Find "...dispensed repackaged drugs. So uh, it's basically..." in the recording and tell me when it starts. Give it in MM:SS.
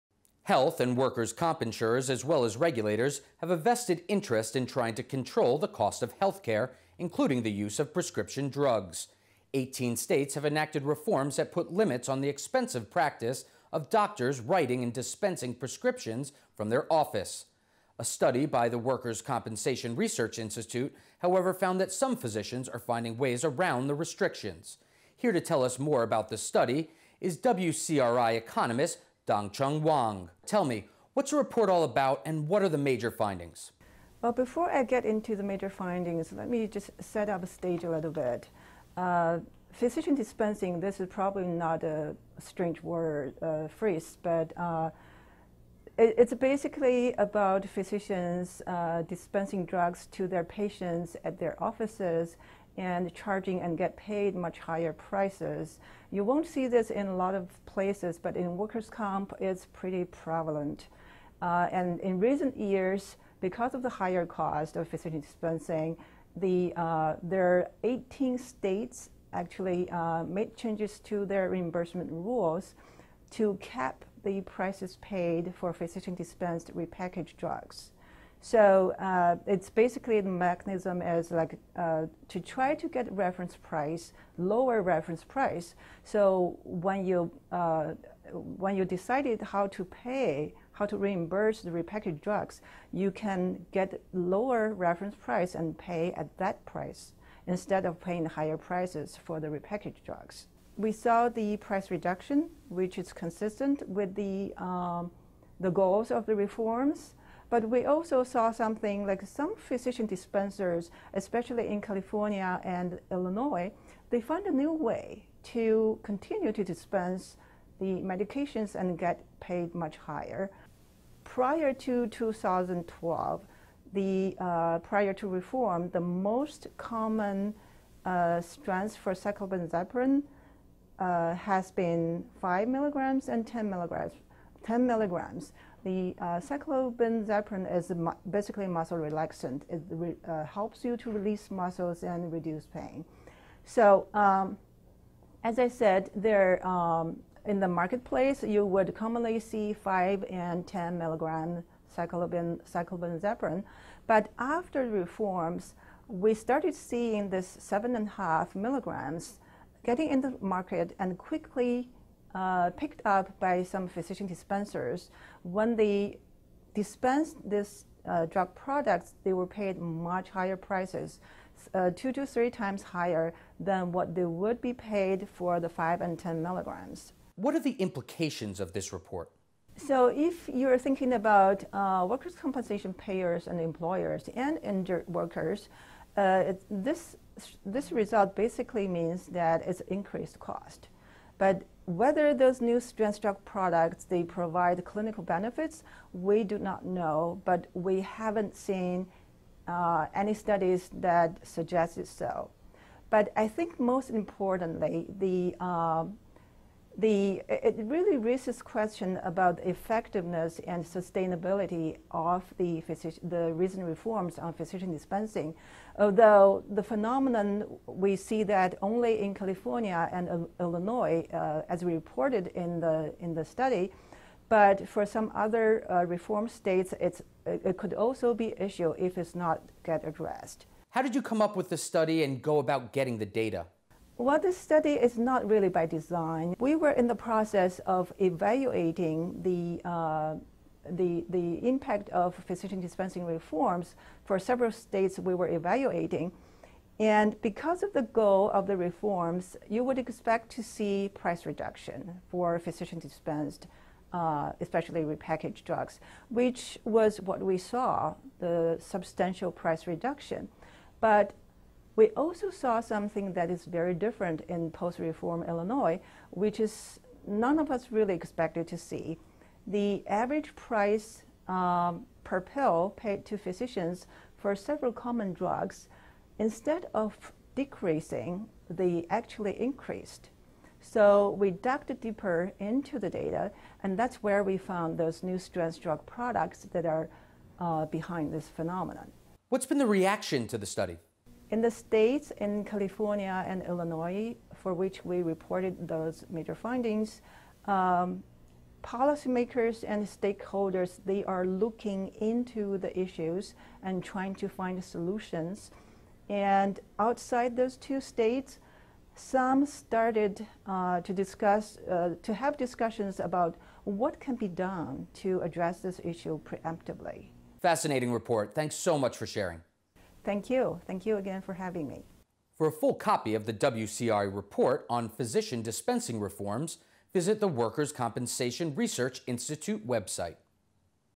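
01:16.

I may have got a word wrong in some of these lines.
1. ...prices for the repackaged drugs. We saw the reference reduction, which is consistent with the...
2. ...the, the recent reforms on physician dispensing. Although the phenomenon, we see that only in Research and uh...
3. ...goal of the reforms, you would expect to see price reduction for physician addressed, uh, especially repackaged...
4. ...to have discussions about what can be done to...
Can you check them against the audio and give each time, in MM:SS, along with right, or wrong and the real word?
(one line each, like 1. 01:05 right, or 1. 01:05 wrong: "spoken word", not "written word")
1. 01:38 wrong: "price", not "reference"
2. 03:32 wrong: "California", not "Research"
3. 04:08 wrong: "dispensed", not "addressed"
4. 05:12 right.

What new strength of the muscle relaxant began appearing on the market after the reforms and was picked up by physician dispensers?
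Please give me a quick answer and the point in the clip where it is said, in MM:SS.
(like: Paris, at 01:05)
7.5 milligrams, at 02:37.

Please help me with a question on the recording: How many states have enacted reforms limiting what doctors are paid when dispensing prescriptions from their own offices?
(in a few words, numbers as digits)
18.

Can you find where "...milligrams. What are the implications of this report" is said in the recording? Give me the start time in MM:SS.
02:56.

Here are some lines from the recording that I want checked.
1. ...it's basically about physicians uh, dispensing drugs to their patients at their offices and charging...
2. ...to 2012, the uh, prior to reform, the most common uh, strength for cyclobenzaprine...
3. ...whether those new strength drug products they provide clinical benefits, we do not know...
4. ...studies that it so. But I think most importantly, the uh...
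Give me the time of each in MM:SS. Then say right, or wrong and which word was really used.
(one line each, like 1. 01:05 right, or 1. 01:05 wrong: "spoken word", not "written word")
1. 00:45 right
2. 02:01 right
3. 03:11 right
4. 03:20 right.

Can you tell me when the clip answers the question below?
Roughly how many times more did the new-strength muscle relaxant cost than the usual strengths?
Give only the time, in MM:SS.
02:51.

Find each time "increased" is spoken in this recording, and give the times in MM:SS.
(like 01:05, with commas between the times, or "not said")
03:09, 04:39.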